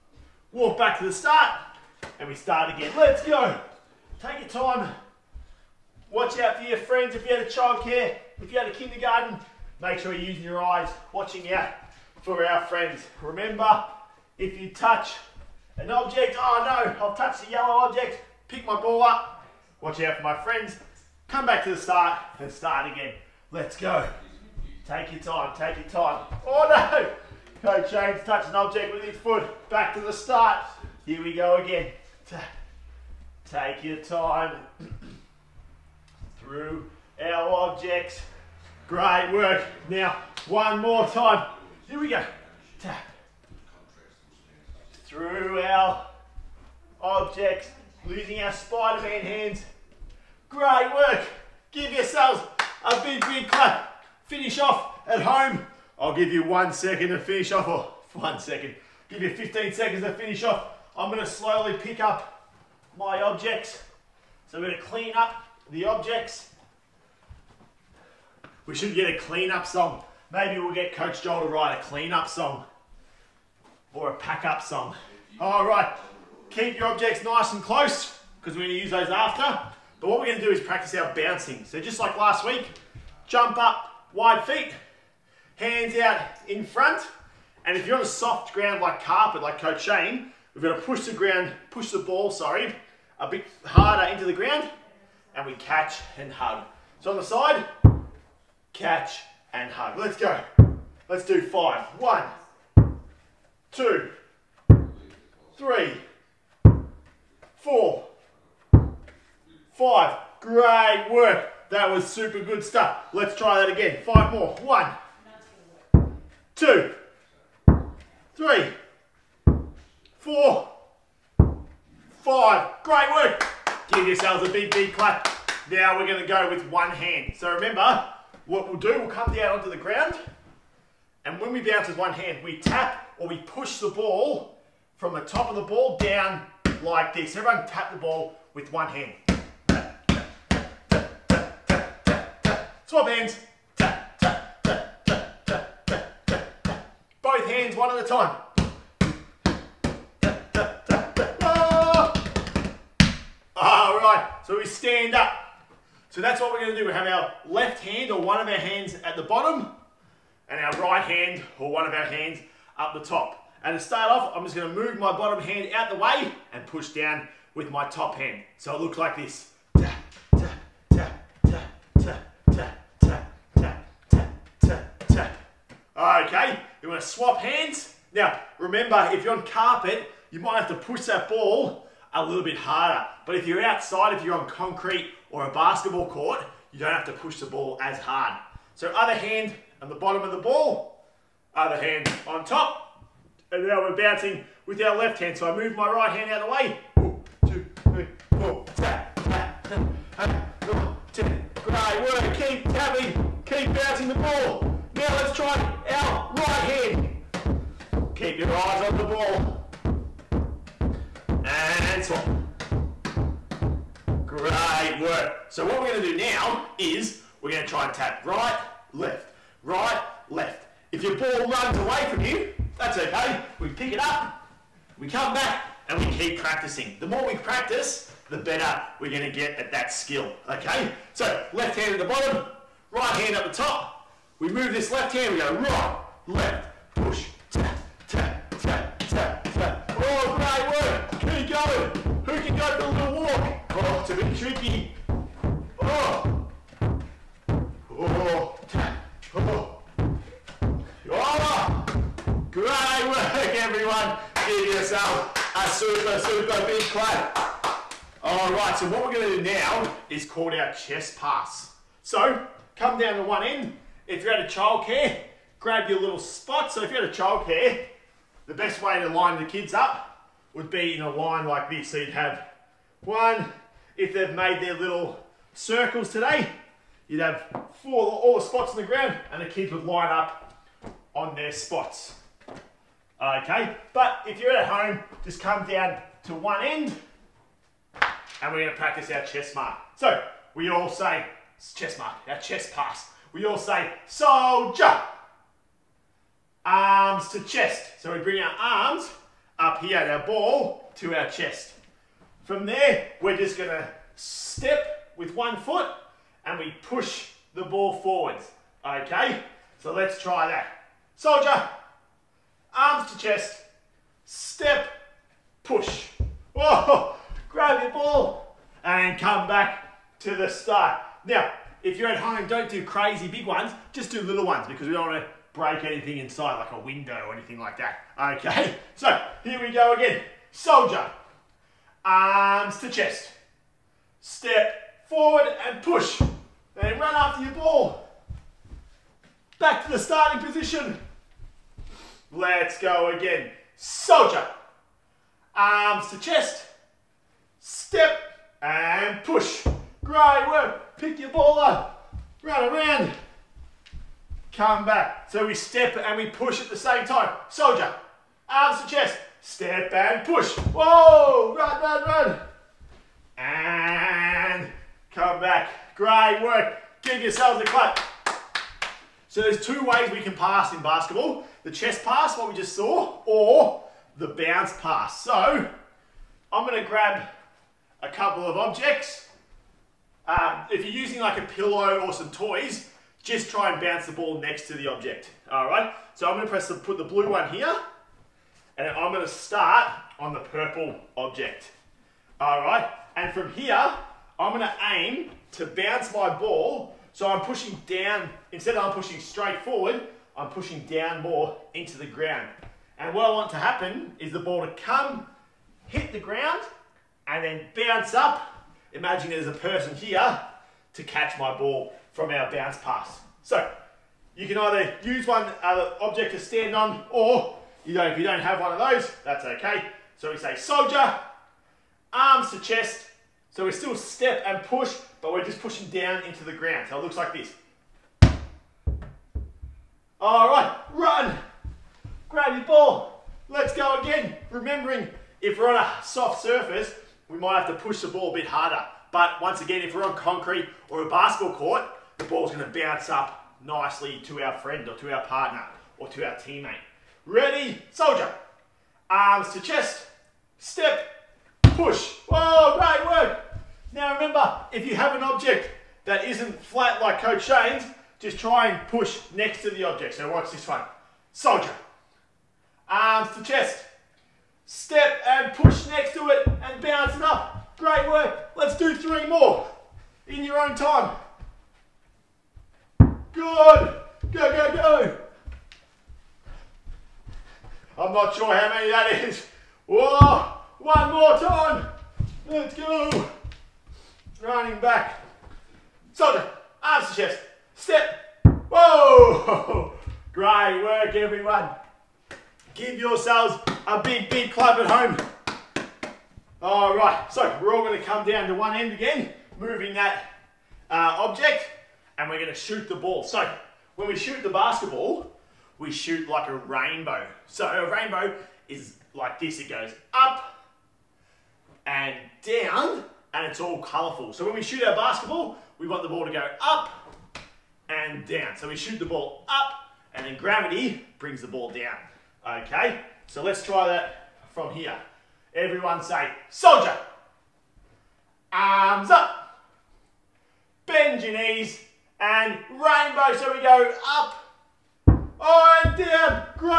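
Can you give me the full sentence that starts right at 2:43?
And to start off, I'm just going to move my bottom hand out the way and push down with my top hand.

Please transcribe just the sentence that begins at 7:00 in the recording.
So we say soldier, arms to chest.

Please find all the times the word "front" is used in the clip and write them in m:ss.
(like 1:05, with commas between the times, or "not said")
1:26.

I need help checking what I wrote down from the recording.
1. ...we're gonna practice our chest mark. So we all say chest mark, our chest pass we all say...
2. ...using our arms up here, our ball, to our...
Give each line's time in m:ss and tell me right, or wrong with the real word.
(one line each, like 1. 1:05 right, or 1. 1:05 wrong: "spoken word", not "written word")
1. 4:48 right
2. 4:58 wrong: "bring", not "using".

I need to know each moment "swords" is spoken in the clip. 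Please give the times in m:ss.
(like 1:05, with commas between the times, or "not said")
not said.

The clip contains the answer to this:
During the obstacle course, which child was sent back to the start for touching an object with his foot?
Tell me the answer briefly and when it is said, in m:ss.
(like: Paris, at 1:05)
James, at 0:27.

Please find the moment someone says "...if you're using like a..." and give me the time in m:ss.
6:20.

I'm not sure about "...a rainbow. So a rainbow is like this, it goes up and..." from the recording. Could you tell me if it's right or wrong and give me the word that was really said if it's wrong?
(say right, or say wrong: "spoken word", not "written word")
right.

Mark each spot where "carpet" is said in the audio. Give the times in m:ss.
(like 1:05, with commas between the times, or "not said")
1:29, 2:59.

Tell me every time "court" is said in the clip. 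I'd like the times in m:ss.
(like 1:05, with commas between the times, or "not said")
3:06, 7:21.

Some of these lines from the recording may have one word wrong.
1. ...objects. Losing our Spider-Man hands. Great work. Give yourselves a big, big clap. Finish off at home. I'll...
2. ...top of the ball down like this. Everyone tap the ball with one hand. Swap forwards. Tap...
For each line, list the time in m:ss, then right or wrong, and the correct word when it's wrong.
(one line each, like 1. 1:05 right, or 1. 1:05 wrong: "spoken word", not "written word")
1. 0:47 right
2. 2:15 wrong: "hands", not "forwards".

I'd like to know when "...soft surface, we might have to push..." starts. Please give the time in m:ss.
7:16.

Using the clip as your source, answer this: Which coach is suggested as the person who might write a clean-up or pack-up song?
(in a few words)
Coach Joel.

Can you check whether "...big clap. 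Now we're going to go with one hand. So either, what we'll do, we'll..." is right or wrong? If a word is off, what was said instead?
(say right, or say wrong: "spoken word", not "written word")
wrong: "remember", not "either".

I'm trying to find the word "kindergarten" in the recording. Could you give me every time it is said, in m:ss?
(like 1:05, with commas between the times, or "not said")
0:08.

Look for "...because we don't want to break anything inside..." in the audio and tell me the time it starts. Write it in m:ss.
5:24.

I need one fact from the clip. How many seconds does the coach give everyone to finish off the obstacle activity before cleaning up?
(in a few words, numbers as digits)
15.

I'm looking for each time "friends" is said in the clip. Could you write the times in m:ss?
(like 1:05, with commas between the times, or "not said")
0:06, 0:12, 0:20, 7:24.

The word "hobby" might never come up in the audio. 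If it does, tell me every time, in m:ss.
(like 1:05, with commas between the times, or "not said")
not said.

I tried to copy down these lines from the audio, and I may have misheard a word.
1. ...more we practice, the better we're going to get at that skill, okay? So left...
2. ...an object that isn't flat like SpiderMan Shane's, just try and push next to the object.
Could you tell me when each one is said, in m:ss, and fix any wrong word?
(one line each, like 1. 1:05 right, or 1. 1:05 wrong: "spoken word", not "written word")
1. 3:47 right
2. 7:35 wrong: "Coach", not "SpiderMan".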